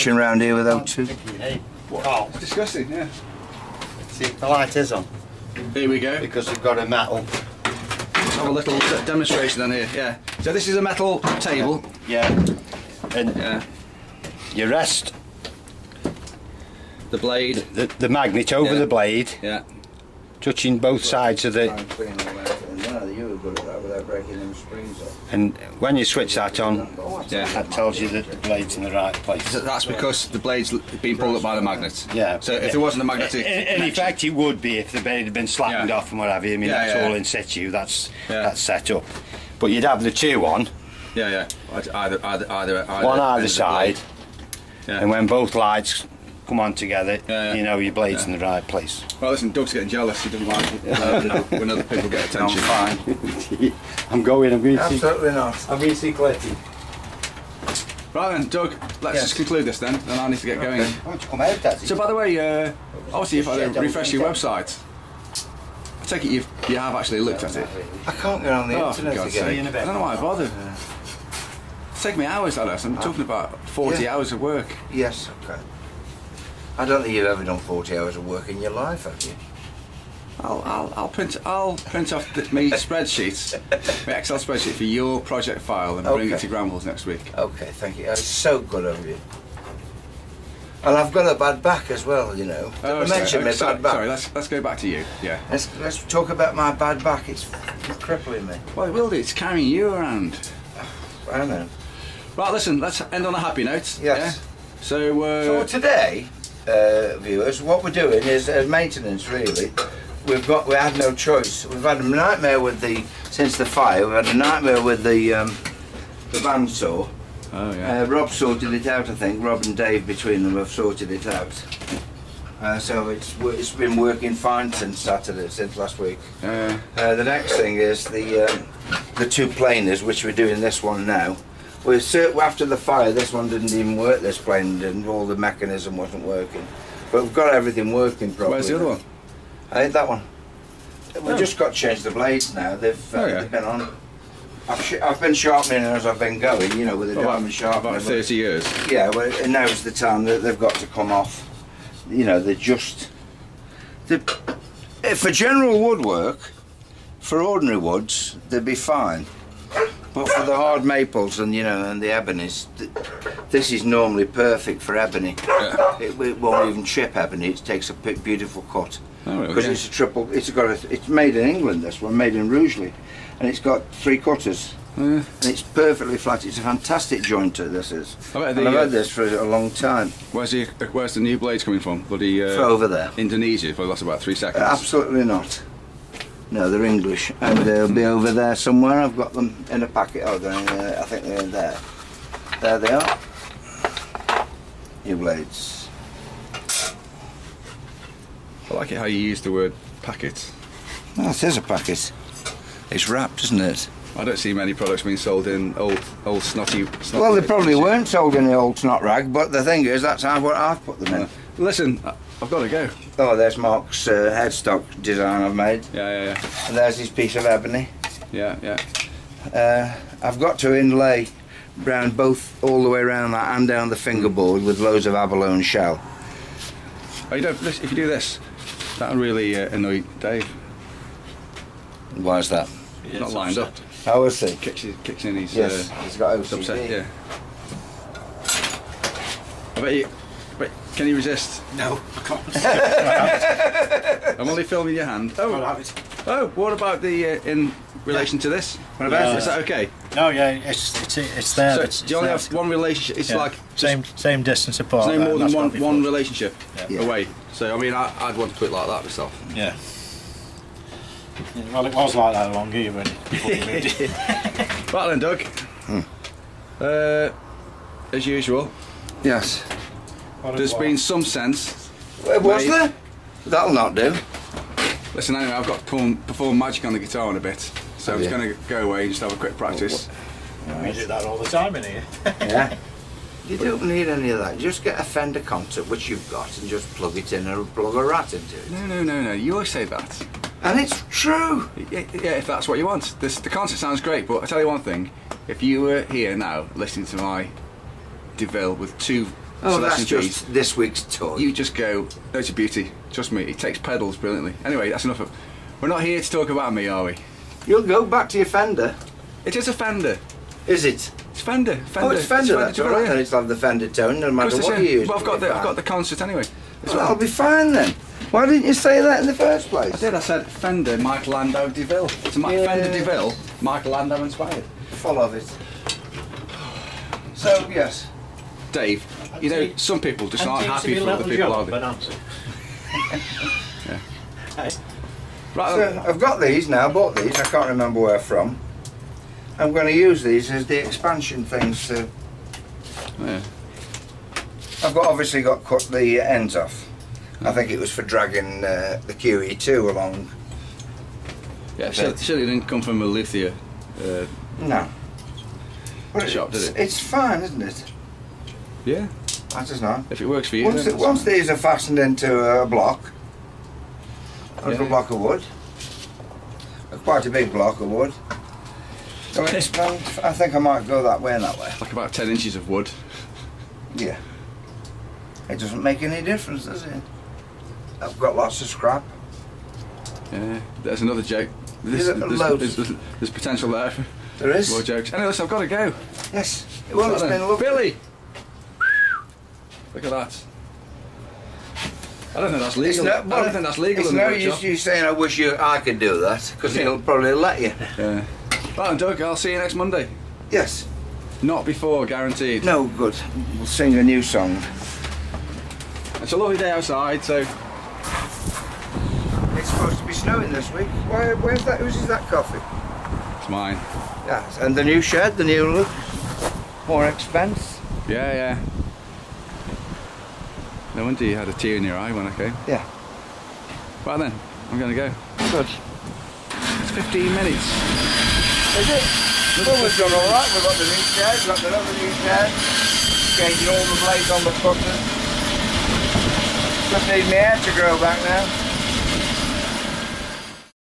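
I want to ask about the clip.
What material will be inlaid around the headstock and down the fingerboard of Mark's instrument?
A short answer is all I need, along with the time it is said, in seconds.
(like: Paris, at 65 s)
abalone shell, at 225 s.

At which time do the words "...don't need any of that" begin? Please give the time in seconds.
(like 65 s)
283 s.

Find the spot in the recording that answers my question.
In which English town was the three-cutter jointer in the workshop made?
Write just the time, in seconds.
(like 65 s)
172 s.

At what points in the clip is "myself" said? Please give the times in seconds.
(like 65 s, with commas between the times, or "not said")
259 s.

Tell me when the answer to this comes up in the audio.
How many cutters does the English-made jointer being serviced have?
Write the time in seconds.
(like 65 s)
173 s.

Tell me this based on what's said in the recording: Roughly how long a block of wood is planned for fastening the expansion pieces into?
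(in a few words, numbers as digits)
10 inches.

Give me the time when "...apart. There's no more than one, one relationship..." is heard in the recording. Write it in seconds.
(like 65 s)
254 s.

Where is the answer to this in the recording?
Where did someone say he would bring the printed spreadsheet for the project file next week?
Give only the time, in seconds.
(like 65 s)
86 s.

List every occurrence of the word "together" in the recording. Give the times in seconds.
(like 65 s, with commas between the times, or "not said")
46 s.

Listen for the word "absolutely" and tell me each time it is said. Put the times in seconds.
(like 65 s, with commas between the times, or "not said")
54 s, 184 s.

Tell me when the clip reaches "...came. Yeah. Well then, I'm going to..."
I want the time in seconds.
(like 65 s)
422 s.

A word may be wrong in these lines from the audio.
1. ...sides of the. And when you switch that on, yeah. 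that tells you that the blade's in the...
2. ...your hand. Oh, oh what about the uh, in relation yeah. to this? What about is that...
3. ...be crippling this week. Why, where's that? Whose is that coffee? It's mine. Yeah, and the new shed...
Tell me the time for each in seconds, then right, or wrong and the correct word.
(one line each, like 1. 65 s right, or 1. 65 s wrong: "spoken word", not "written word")
1. 21 s right
2. 244 s right
3. 410 s wrong: "snowing", not "crippling".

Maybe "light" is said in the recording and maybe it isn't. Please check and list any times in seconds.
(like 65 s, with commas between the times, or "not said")
4 s, 45 s.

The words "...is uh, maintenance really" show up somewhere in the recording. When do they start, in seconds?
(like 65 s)
108 s.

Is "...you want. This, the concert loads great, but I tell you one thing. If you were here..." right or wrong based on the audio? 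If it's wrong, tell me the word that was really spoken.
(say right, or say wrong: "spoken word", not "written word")
wrong: "sounds", not "loads".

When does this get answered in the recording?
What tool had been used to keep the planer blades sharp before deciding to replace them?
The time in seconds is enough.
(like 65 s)
147 s.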